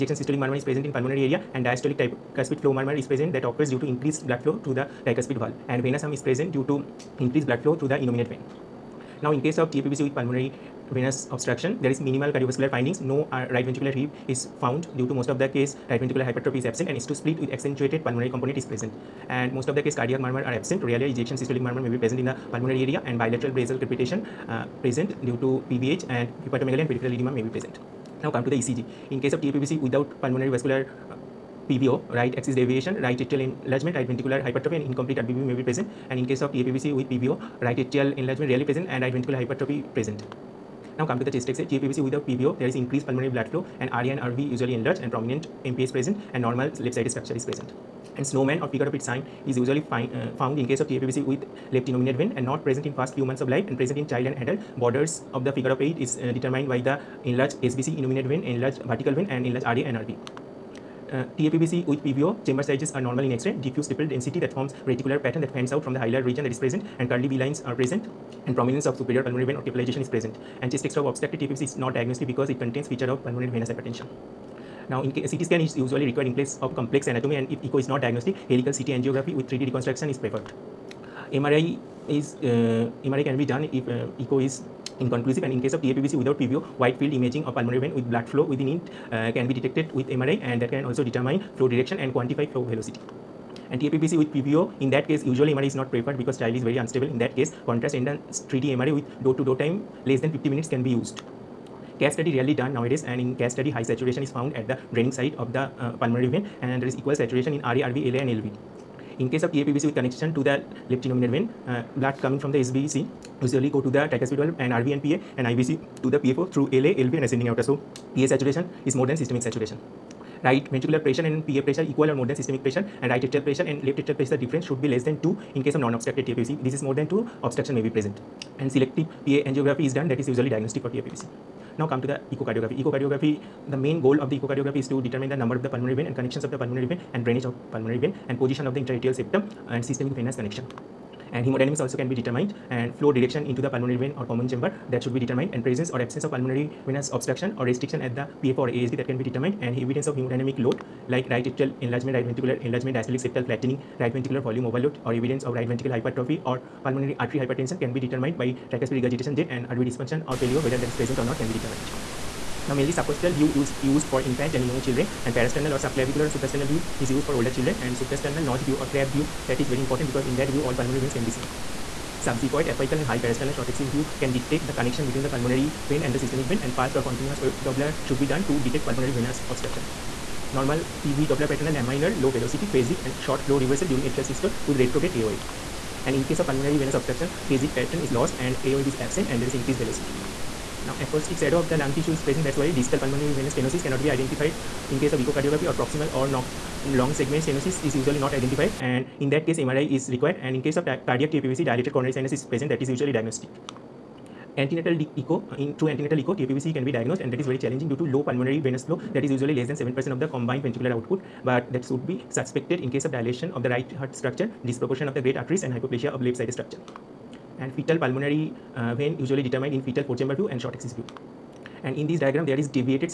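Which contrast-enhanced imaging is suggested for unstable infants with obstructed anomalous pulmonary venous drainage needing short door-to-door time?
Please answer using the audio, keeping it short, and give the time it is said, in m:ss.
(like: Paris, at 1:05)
Contrast enhanced 3D MRI, at 1:37.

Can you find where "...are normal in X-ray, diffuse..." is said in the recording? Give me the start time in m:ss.
1:02.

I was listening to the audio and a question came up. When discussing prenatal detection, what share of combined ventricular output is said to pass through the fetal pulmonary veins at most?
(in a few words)
7%.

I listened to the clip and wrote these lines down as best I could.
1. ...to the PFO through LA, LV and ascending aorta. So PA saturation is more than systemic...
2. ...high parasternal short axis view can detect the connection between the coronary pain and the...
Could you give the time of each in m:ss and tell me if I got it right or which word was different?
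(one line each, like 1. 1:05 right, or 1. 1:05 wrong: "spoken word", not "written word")
1. 1:56 right
2. 2:53 wrong: "pulmonary", not "coronary".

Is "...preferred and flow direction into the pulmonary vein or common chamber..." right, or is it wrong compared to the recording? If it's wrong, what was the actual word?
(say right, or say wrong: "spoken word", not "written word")
wrong: "determined", not "preferred".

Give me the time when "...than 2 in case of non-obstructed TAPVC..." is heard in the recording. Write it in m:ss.
2:05.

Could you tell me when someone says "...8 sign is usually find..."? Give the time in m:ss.
0:48.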